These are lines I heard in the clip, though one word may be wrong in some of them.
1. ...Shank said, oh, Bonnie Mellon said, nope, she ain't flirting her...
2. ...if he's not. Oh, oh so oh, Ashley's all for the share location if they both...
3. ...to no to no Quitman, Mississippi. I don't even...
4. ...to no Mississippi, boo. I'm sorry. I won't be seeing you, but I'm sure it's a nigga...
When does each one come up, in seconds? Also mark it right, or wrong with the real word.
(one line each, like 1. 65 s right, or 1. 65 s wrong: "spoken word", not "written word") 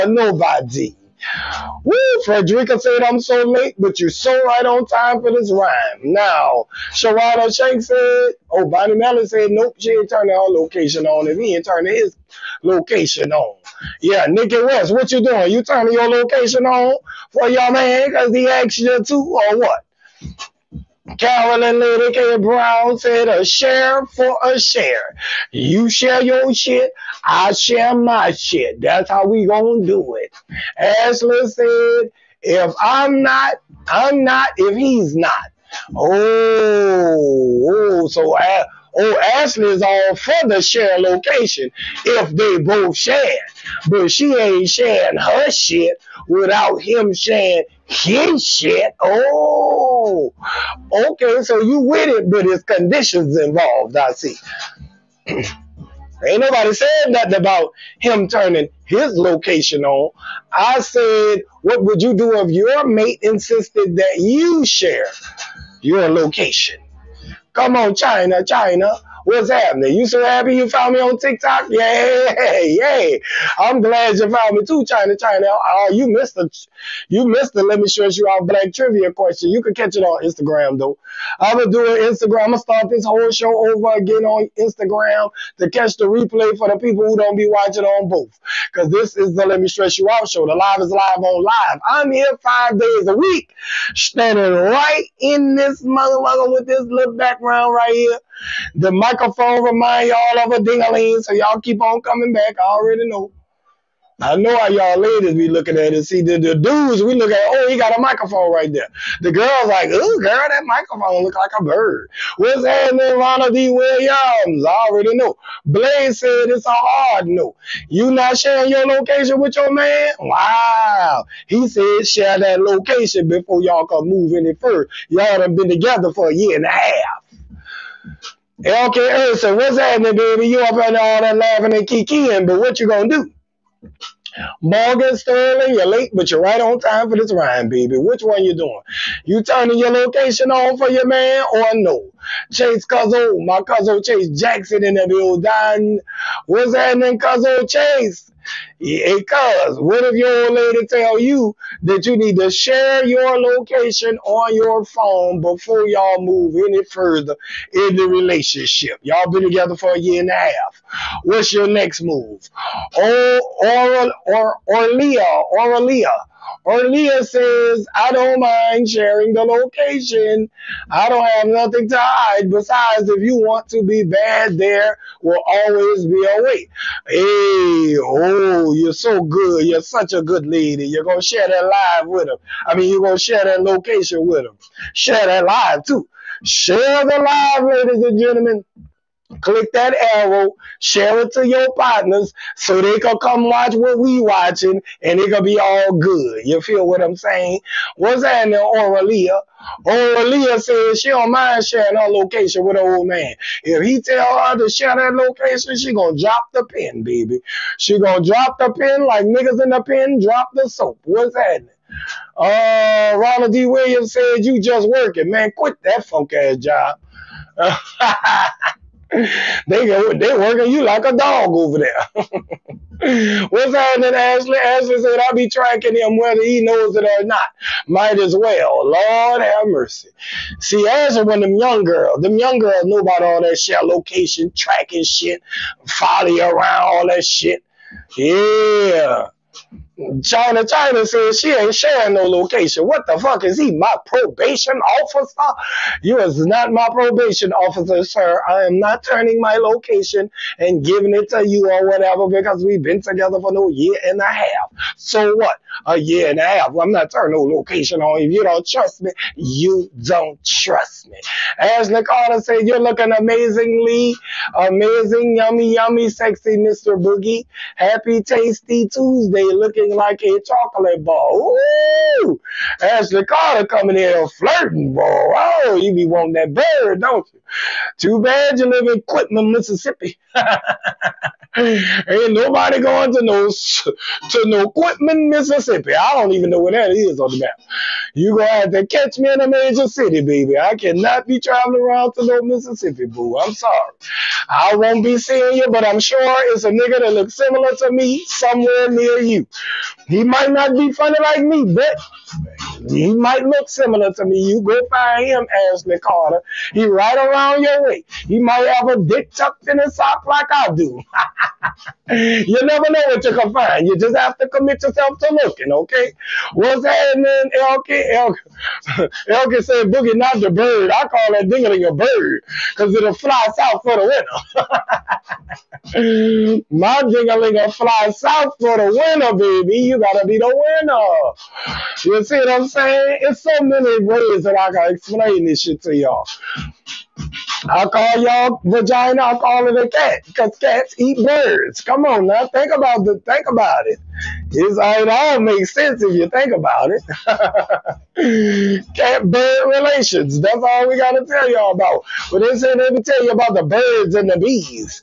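1. 7 s wrong: "turning", not "flirting"
2. 34 s right
3. 283 s right
4. 292 s right.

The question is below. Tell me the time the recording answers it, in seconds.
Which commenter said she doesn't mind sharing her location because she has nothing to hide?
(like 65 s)
165 s.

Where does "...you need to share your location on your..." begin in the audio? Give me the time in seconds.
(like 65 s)
152 s.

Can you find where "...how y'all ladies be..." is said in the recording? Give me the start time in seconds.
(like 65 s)
104 s.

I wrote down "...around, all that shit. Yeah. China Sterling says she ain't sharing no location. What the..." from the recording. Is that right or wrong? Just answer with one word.
wrong.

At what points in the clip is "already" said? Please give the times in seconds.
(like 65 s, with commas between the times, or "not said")
102 s, 114 s.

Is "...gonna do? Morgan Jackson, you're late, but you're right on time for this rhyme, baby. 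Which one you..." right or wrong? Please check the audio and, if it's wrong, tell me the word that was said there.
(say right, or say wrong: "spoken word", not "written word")
wrong: "Sterling", not "Jackson".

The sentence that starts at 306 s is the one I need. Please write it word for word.
He right around down your You might have a dick tucked in his sock like I do.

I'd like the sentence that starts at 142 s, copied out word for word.
Chase Cuzzo, my cousin Chase Jackson in the building.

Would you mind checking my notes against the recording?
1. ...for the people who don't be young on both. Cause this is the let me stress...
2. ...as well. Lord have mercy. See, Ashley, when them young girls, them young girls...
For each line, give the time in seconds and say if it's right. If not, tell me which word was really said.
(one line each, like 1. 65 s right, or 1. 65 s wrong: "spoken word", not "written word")
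1. 86 s wrong: "watching", not "young"
2. 228 s right.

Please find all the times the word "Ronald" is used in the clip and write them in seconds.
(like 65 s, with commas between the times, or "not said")
113 s, 213 s.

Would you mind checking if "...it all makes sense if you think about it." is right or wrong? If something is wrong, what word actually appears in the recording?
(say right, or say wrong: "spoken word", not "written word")
right.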